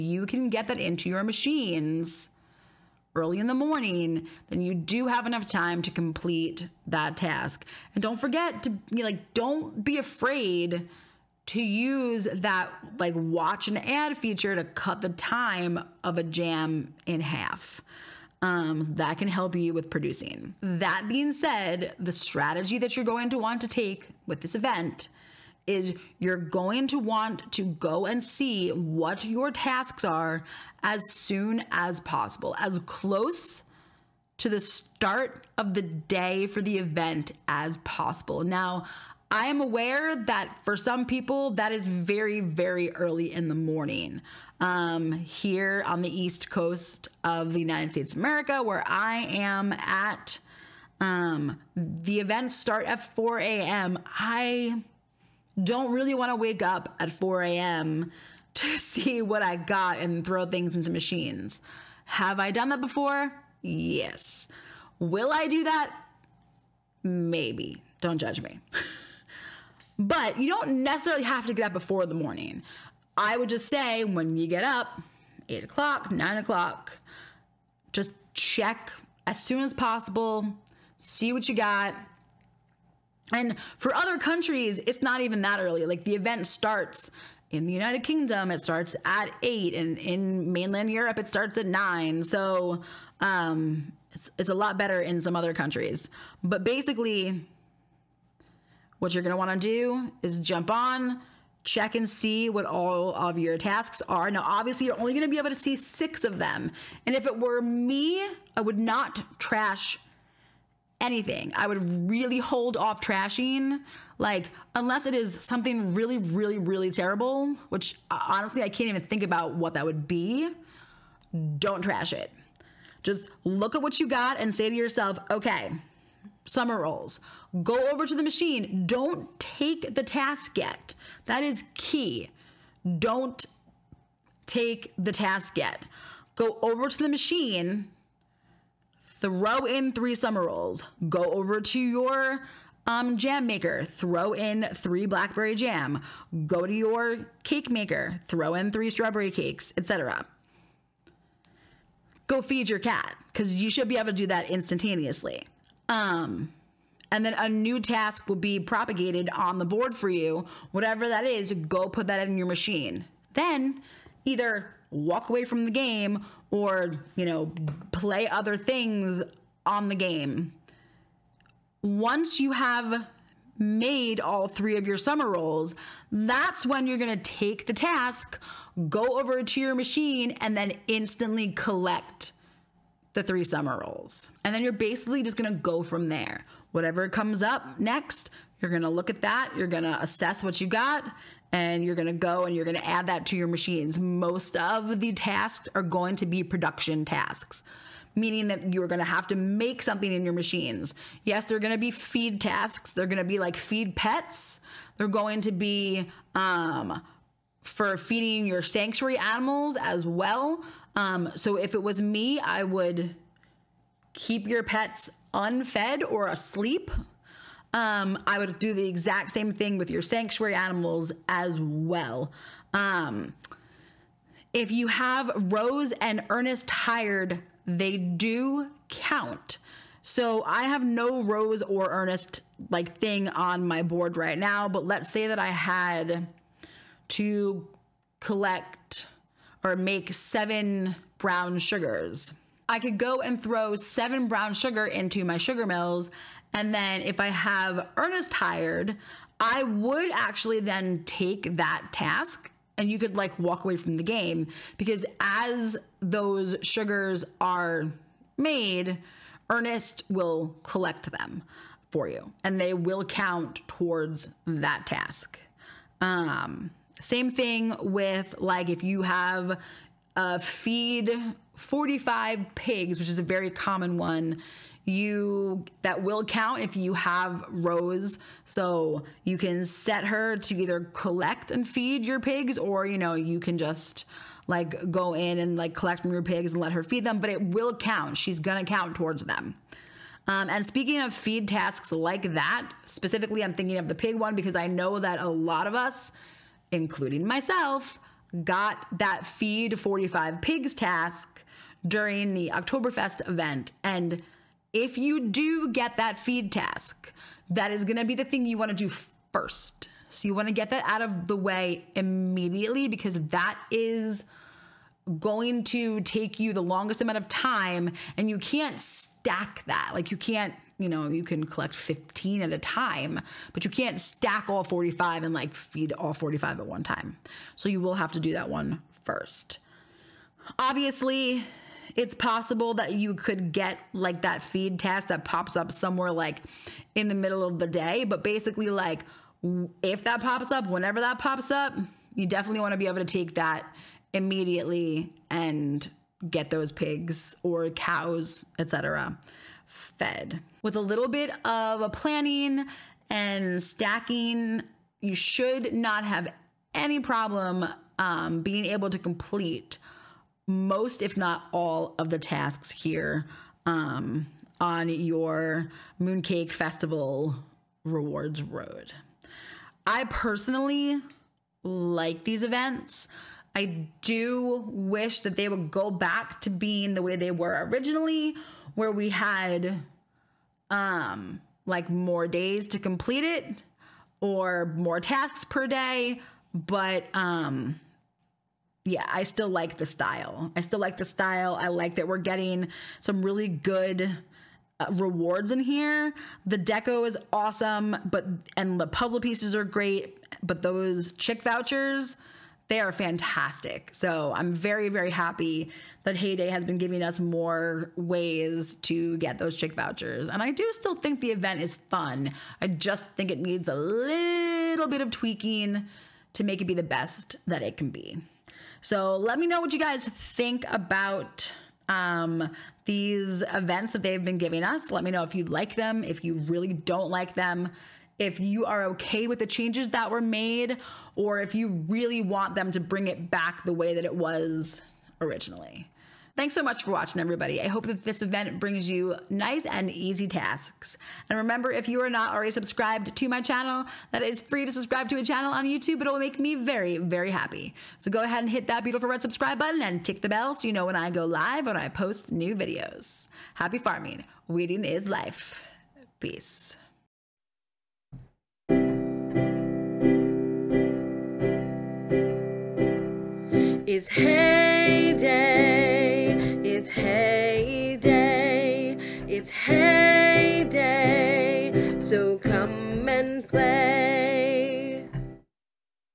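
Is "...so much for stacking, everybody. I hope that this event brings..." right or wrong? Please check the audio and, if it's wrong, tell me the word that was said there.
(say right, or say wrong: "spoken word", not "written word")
wrong: "watching", not "stacking".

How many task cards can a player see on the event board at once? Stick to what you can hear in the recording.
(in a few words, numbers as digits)
6.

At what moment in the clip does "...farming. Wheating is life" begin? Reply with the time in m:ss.
7:33.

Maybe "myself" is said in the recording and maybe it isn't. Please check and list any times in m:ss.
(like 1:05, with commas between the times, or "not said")
4:57.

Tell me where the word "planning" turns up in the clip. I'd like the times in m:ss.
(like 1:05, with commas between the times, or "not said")
5:51.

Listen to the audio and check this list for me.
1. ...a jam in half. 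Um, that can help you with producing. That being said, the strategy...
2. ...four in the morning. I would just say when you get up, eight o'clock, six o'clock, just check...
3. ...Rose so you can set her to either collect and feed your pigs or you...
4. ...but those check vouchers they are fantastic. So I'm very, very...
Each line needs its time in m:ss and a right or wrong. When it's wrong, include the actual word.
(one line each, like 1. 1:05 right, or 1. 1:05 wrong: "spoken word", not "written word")
1. 0:16 right
2. 1:11 wrong: "nine", not "six"
3. 4:37 right
4. 6:40 wrong: "chick", not "check".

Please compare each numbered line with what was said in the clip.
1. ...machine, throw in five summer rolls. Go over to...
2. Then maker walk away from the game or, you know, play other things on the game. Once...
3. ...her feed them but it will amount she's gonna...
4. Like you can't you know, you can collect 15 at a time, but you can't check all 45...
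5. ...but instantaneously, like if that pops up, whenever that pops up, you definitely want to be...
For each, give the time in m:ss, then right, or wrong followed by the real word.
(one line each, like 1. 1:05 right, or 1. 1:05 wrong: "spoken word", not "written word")
1. 2:17 wrong: "three", not "five"
2. 2:43 wrong: "either", not "maker"
3. 4:46 wrong: "count", not "amount"
4. 5:19 wrong: "stack", not "check"
5. 5:38 wrong: "basically", not "instantaneously".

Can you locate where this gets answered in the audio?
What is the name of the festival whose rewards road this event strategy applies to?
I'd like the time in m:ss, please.
6:06.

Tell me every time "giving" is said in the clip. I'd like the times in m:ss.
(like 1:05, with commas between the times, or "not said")
6:46, 7:04.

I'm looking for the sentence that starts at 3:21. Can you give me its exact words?
Yes, they're going to be feed tasks.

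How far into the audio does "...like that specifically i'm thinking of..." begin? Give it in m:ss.
4:51.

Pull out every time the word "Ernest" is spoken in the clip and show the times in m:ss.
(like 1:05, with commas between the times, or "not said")
3:46, 3:51, 4:07, 4:19.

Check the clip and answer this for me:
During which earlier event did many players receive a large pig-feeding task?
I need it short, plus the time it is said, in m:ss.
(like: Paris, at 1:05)
Oktoberfest, at 5:02.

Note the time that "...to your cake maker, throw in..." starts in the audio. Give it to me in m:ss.
2:26.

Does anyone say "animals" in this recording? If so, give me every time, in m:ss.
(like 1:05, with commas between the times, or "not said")
3:29, 3:40.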